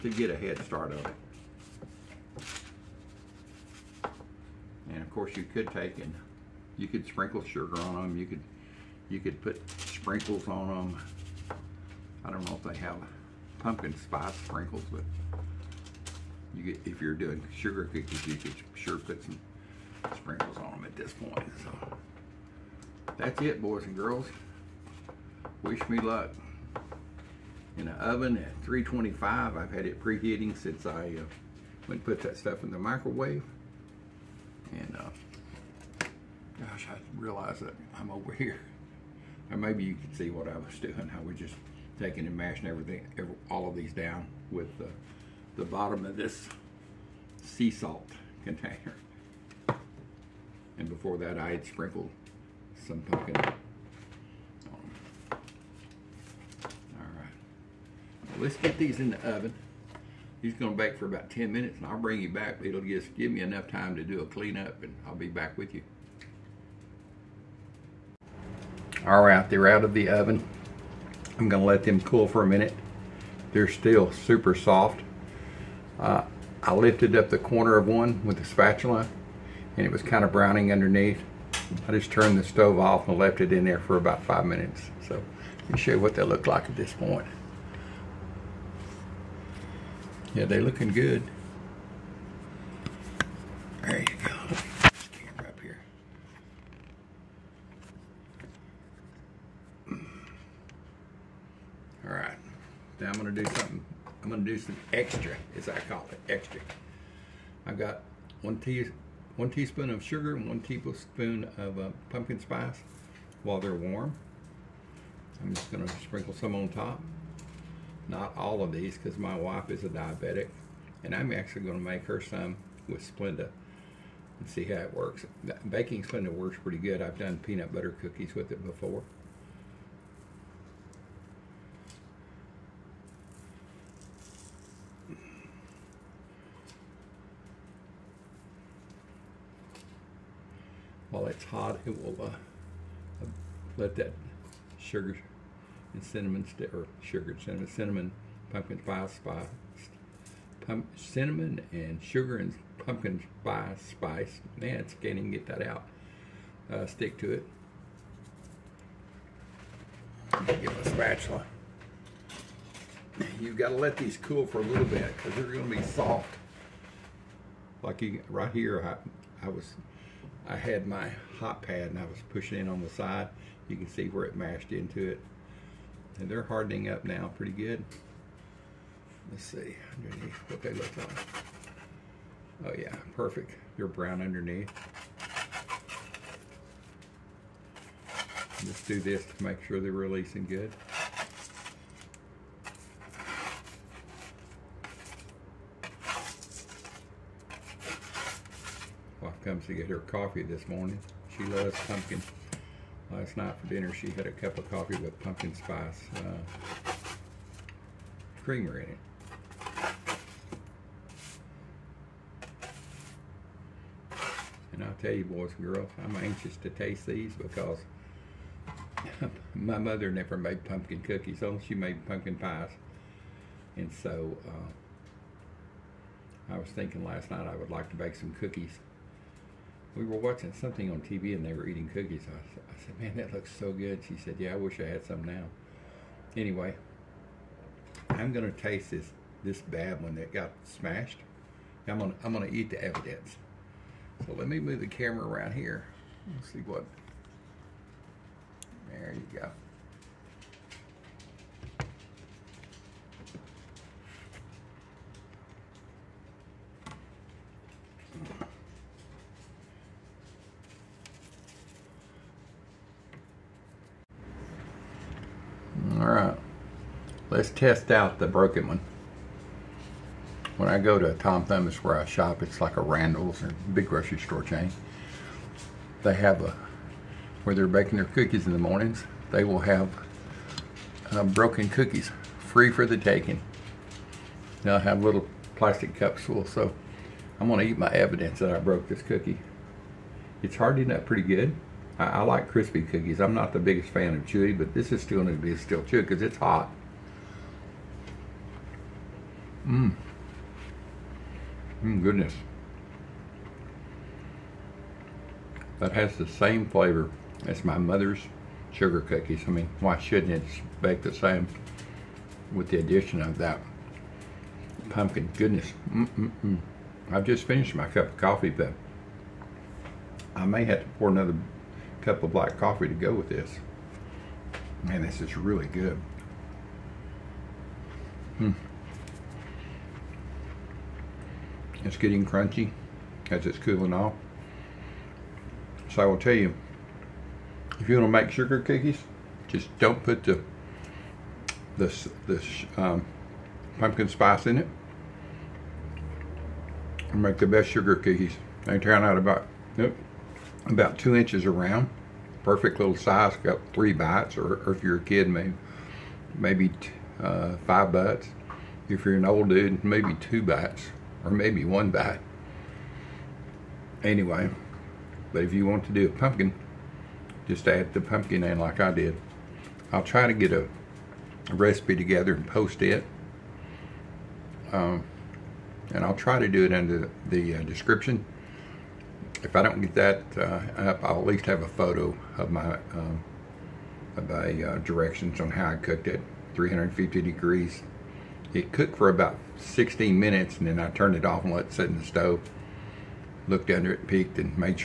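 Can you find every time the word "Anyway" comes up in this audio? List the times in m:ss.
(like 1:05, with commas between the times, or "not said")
3:56, 6:04.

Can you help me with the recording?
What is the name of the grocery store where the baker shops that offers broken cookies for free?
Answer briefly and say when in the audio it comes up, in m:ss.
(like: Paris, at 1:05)
Tom Thumb's, at 4:31.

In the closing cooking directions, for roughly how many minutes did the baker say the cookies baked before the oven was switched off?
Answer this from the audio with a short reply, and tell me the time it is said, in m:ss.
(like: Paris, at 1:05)
16 minutes, at 6:29.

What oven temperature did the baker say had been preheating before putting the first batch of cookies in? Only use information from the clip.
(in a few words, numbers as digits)
325.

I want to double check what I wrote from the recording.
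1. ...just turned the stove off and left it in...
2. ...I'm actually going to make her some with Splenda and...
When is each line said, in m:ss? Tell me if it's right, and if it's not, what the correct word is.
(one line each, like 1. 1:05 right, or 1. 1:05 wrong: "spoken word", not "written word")
1. 1:21 right
2. 2:01 right.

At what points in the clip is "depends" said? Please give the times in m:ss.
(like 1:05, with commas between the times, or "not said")
not said.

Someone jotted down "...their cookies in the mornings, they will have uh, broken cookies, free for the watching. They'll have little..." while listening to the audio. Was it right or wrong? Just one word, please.
wrong.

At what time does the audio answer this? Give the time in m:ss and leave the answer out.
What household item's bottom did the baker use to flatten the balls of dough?
0:47.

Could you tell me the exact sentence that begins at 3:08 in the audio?
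Just do this to make sure they're releasing good.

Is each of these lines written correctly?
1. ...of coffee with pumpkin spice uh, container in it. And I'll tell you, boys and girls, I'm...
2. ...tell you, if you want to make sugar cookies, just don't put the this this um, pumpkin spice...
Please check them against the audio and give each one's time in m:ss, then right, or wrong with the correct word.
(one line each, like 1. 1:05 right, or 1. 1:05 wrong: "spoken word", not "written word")
1. 3:24 wrong: "creamer", not "container"
2. 5:36 right.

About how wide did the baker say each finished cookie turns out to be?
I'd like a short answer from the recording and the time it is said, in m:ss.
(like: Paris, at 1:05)
2 inches, at 5:50.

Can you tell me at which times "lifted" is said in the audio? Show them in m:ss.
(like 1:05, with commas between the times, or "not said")
1:16.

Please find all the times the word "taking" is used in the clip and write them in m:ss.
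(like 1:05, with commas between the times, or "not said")
0:41, 4:42.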